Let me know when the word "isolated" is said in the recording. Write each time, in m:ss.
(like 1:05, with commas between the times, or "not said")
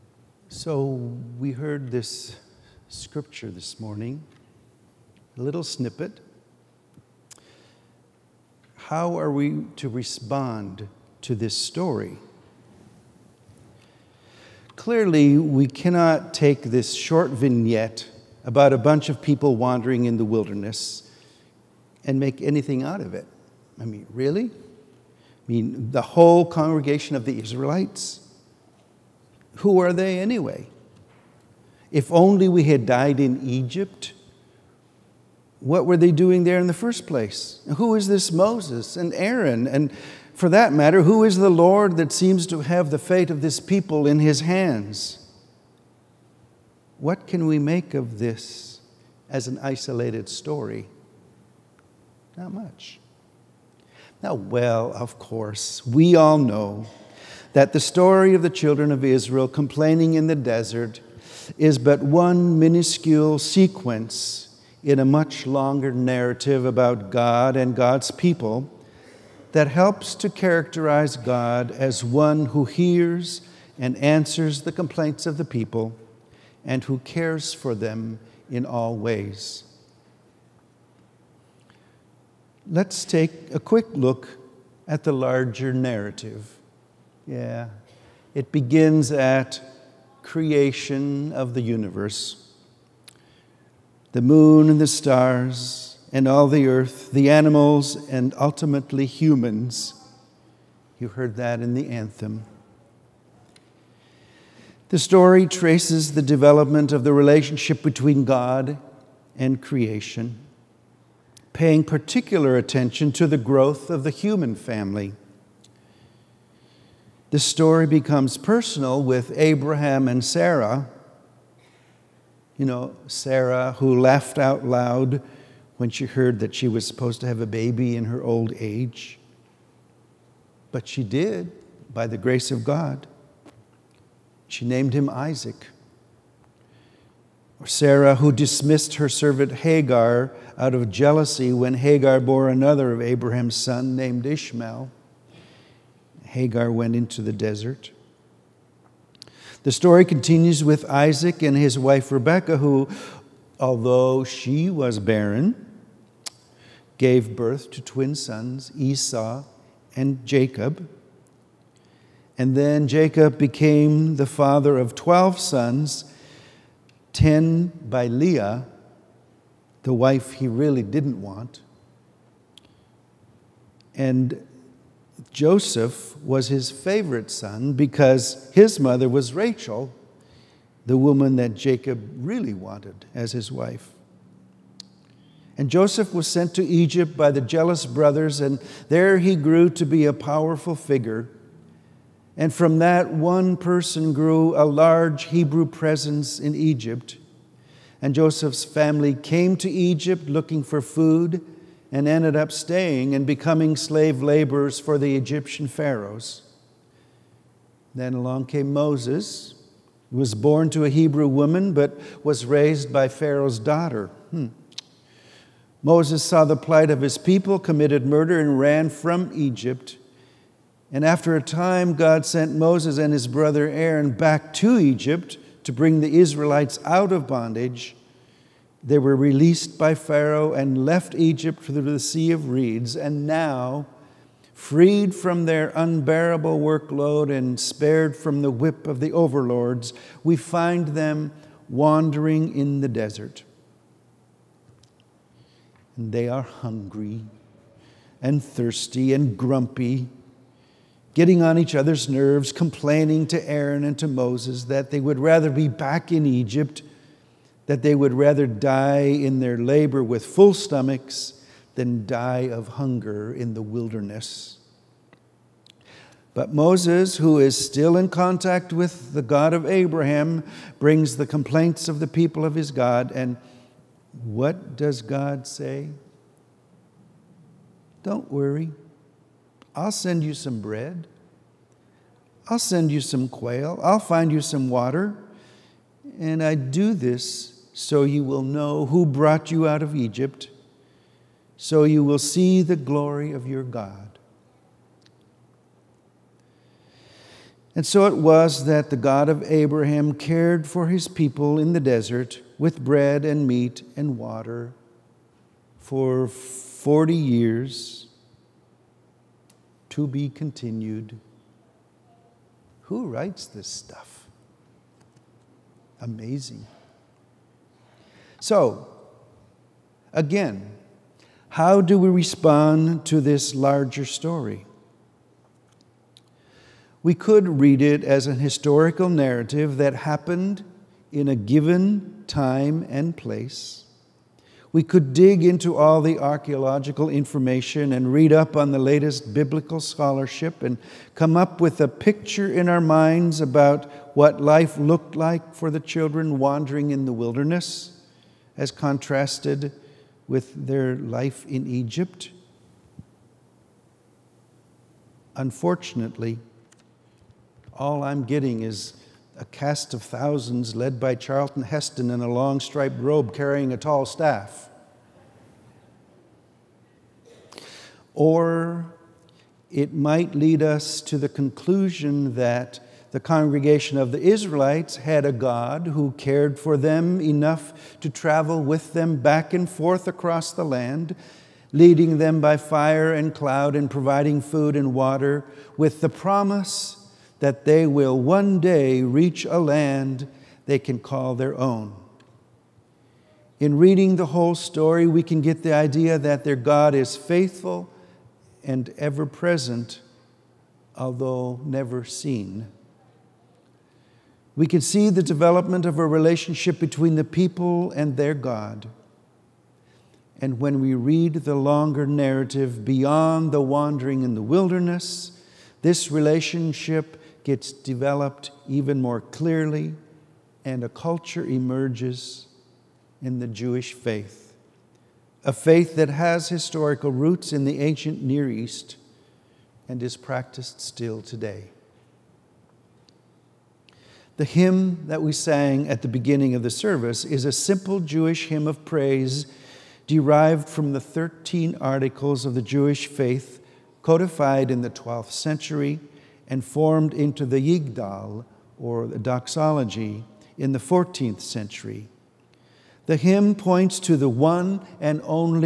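0:49.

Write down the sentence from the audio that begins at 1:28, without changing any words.
It begins at creation of the universe.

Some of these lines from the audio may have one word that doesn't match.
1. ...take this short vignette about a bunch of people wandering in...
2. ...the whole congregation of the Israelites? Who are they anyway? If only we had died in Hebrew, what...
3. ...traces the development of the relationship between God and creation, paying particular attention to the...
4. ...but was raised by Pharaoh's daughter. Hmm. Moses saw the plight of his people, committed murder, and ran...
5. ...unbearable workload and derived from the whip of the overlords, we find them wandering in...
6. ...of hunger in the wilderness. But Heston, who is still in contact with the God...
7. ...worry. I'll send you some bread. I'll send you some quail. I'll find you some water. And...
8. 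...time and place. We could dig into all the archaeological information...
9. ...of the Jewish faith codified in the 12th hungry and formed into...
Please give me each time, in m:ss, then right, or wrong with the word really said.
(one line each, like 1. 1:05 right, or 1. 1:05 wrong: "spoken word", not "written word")
1. 0:16 right
2. 0:25 wrong: "Egypt", not "Hebrew"
3. 1:45 right
4. 3:31 right
5. 3:55 wrong: "spared", not "derived"
6. 4:22 wrong: "Moses", not "Heston"
7. 4:38 right
8. 5:32 right
9. 7:22 wrong: "century", not "hungry".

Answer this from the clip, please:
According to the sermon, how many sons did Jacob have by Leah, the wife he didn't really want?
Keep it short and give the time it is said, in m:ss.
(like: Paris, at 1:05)
10, at 2:47.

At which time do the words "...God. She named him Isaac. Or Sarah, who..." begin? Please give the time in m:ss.
2:12.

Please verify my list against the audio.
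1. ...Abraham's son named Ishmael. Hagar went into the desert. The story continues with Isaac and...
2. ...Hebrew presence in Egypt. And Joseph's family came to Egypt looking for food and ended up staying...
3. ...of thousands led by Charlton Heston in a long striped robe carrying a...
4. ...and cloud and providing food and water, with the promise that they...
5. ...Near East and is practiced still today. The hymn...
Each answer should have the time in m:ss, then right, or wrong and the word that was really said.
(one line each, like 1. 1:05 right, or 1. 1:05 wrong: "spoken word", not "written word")
1. 2:23 right
2. 3:15 right
3. 5:59 right
4. 6:23 right
5. 7:08 right.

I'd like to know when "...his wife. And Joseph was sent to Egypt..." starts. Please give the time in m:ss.
3:03.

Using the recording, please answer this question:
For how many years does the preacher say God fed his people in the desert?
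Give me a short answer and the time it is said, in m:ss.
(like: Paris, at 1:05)
40, at 5:06.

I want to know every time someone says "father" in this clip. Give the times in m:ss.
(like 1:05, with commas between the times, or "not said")
2:44.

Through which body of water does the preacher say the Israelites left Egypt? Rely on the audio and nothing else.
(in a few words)
Sea of Reeds.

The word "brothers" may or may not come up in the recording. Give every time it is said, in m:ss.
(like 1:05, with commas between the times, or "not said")
3:07, 3:43.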